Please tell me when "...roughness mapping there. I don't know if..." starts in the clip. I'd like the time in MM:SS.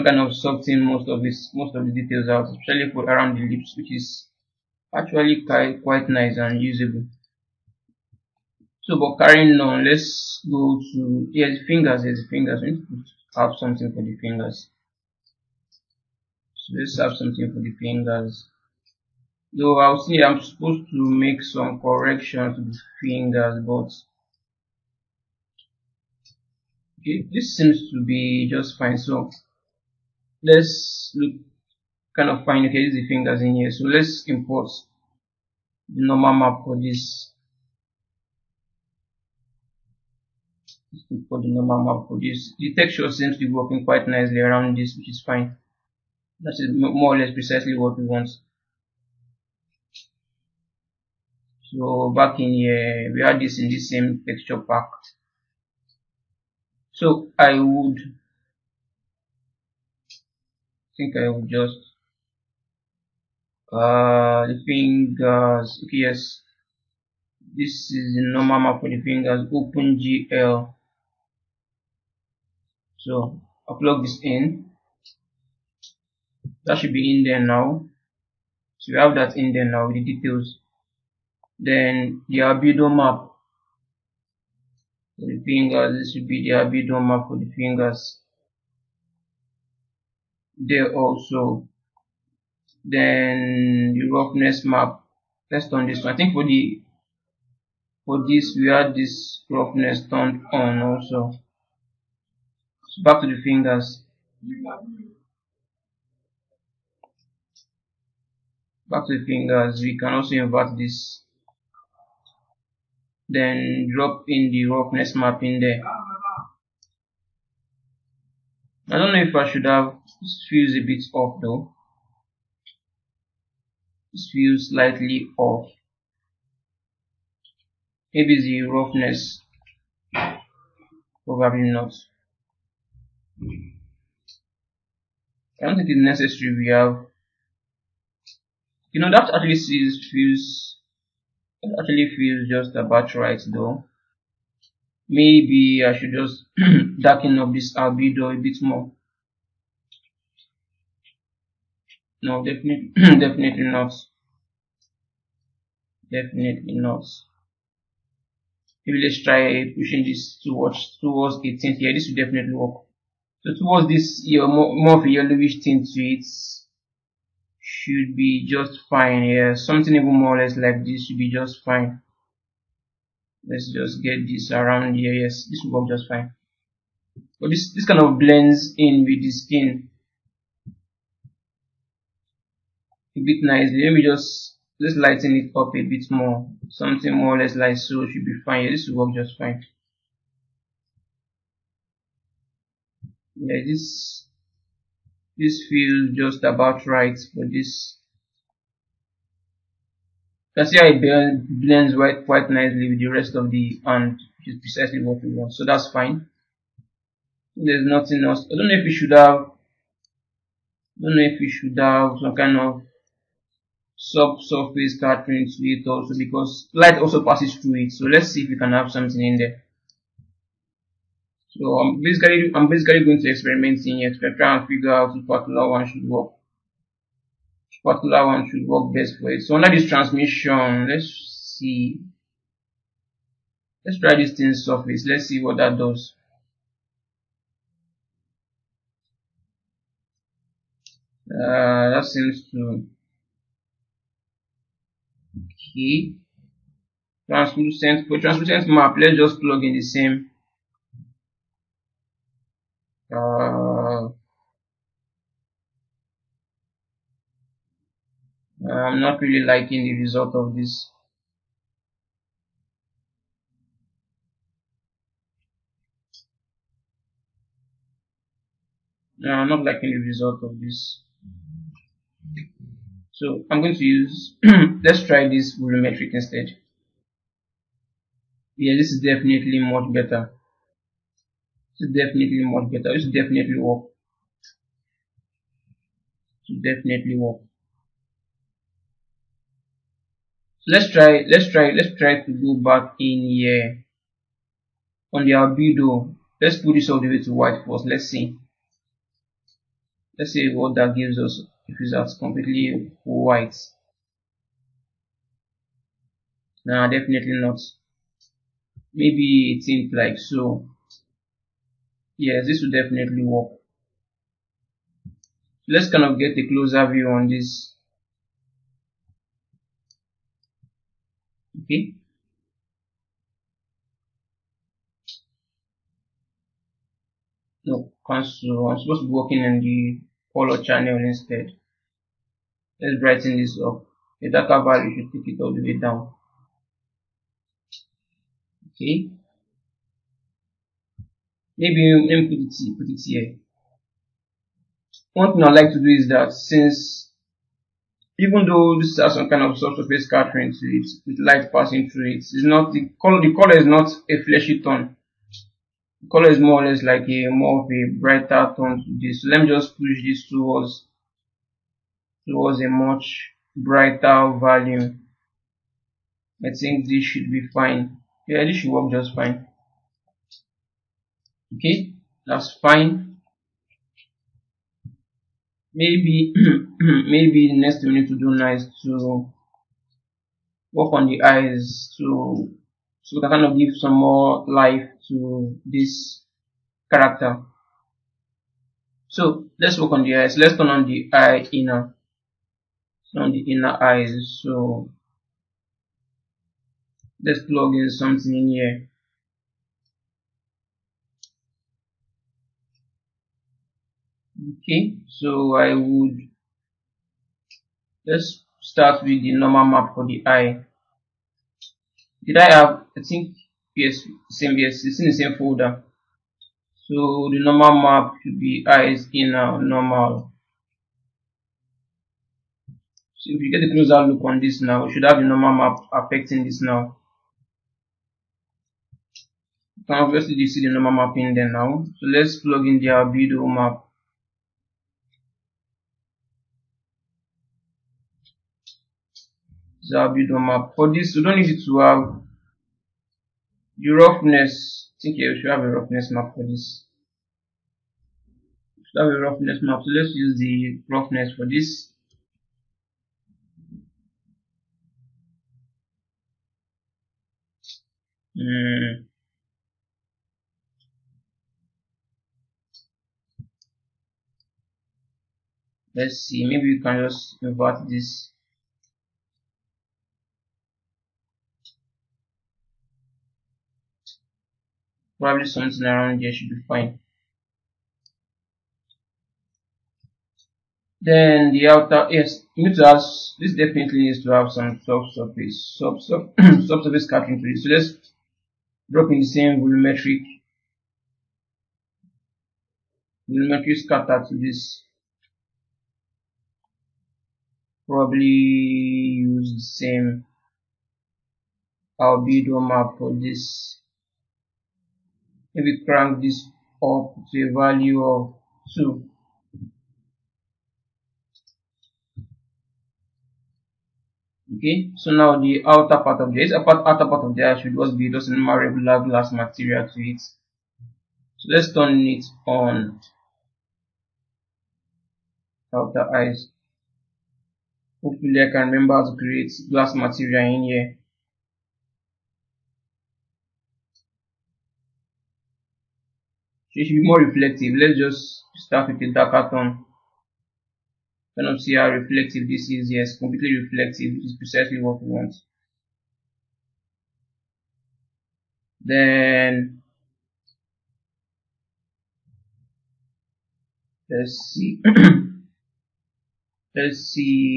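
01:54.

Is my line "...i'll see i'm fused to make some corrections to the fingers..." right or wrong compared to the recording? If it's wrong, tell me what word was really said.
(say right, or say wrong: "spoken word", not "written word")
wrong: "supposed", not "fused".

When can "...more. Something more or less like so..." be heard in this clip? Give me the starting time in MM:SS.
03:06.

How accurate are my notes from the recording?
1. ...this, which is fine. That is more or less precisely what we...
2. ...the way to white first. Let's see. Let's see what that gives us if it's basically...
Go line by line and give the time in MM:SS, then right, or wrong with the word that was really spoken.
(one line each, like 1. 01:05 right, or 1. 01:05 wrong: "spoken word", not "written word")
1. 00:44 right
2. 04:57 wrong: "completely", not "basically".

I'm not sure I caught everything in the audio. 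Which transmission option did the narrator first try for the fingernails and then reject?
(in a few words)
Thin surface.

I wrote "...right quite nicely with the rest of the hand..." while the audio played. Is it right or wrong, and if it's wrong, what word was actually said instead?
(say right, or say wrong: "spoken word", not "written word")
right.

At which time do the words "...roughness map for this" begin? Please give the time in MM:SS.
07:25.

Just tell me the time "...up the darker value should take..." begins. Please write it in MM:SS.
05:33.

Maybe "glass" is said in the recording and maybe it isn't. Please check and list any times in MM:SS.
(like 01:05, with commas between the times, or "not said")
08:39, 08:49.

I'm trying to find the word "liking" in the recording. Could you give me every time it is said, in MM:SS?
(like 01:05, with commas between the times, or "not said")
04:19, 04:29.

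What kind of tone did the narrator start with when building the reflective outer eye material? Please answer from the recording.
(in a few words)
Dark tone.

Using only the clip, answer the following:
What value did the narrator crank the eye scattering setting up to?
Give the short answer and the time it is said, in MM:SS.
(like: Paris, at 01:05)
2, at 08:28.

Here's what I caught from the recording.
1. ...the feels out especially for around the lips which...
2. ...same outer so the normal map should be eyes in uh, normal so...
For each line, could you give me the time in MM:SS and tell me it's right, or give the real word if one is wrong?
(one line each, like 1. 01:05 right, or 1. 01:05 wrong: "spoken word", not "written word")
1. 00:01 wrong: "details", not "feels"
2. 06:55 wrong: "folder", not "outer".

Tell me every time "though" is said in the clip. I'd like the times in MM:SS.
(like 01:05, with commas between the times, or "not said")
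00:19, 02:01, 02:23, 05:48.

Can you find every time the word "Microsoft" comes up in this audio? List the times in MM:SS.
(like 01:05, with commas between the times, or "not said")
not said.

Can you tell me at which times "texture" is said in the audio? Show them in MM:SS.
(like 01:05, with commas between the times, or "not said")
00:42, 00:54.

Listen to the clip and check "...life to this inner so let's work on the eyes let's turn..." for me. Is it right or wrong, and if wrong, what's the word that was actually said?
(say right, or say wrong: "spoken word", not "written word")
wrong: "character", not "inner".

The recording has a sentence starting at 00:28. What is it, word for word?
So let's look kind of fine.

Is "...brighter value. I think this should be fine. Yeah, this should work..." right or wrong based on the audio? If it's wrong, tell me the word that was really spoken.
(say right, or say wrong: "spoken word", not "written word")
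right.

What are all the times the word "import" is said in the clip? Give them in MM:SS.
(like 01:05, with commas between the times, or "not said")
00:34, 00:41.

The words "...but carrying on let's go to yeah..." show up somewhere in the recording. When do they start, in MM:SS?
00:08.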